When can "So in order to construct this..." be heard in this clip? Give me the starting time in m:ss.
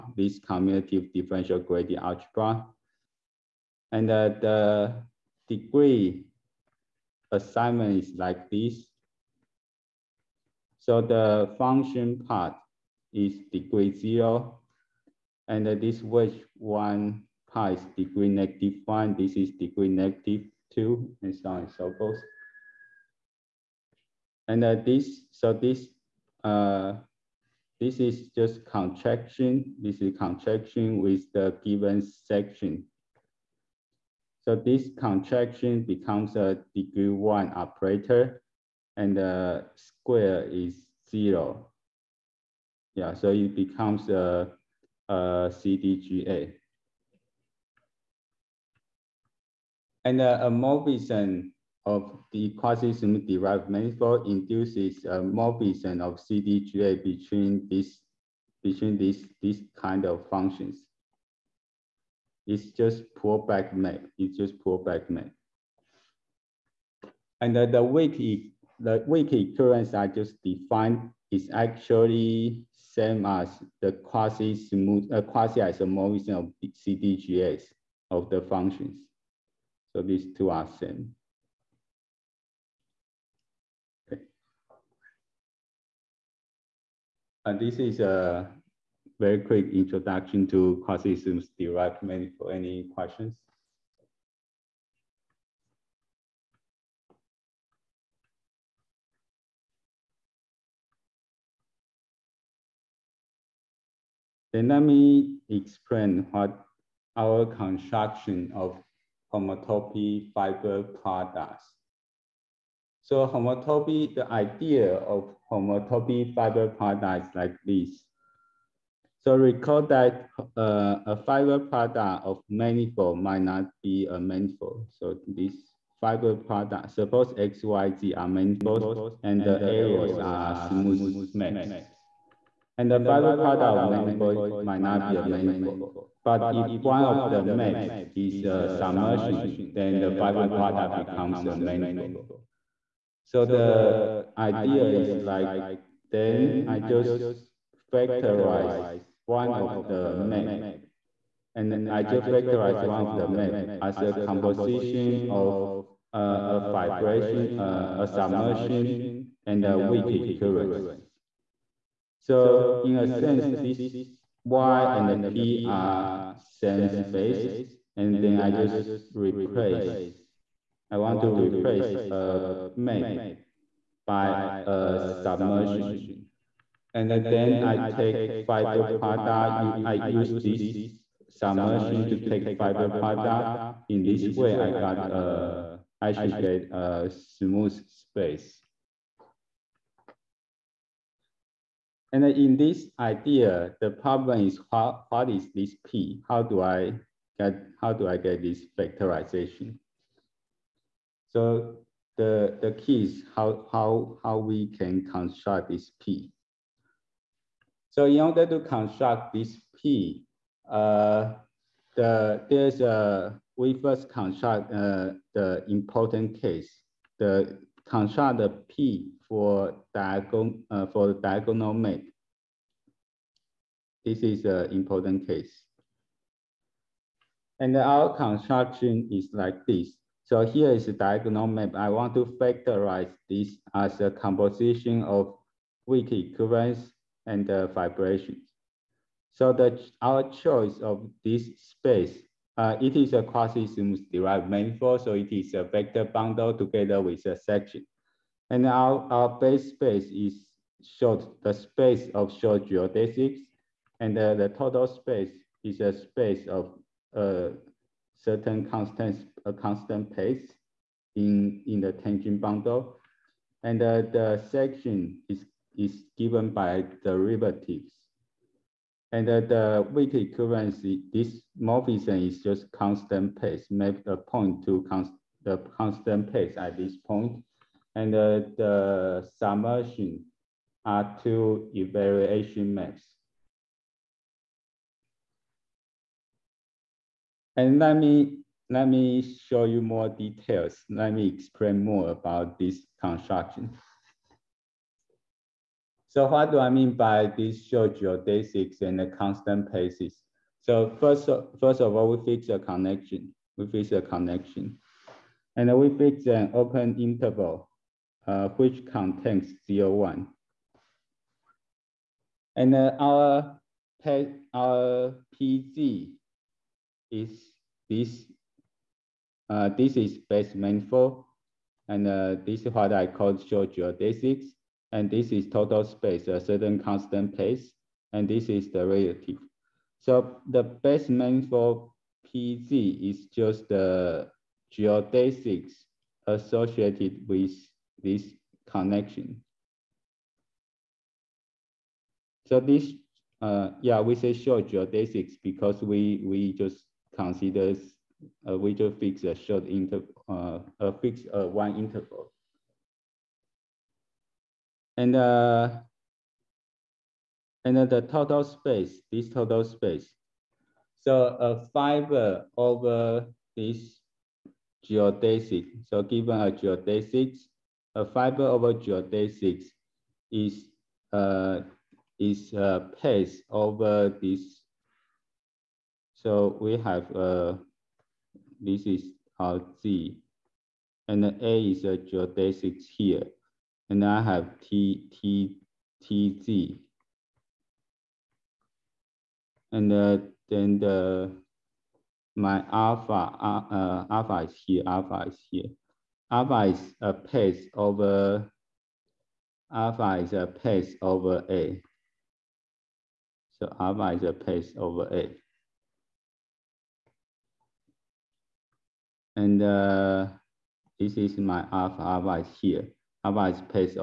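3:27.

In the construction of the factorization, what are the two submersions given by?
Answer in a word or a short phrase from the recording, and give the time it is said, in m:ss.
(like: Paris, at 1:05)
evaluation maps, at 4:41.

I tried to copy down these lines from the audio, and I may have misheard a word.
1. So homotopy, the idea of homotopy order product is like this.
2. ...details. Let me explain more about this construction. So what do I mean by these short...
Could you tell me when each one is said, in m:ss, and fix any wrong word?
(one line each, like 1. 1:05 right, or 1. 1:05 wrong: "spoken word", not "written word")
1. 1:53 wrong: "fiber", not "order"
2. 4:50 right.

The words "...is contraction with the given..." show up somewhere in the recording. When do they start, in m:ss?
0:30.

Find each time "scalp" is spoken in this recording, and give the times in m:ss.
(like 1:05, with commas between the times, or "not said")
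not said.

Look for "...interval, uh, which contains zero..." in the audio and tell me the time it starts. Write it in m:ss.
5:06.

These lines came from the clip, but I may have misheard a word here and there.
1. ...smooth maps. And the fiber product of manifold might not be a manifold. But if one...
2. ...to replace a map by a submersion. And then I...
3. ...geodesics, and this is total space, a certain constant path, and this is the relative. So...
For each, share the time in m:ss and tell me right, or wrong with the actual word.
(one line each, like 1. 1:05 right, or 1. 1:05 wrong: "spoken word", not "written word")
1. 2:10 right
2. 2:51 right
3. 5:23 right.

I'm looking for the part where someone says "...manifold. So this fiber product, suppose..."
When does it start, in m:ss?
2:04.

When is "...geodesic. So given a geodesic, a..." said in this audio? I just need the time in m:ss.
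6:04.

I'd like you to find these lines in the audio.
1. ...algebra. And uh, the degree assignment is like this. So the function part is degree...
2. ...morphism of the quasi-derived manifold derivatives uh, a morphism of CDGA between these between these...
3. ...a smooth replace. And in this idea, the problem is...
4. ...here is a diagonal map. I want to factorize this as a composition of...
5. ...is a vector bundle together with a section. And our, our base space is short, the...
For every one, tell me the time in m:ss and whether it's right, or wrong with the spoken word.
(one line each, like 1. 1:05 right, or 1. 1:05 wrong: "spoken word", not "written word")
1. 0:01 right
2. 0:50 wrong: "induces", not "derivatives"
3. 3:06 wrong: "space", not "replace"
4. 3:50 right
5. 4:05 right.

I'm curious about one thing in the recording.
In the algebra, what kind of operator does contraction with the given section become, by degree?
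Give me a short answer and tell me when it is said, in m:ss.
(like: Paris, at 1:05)
degree one operator, at 0:36.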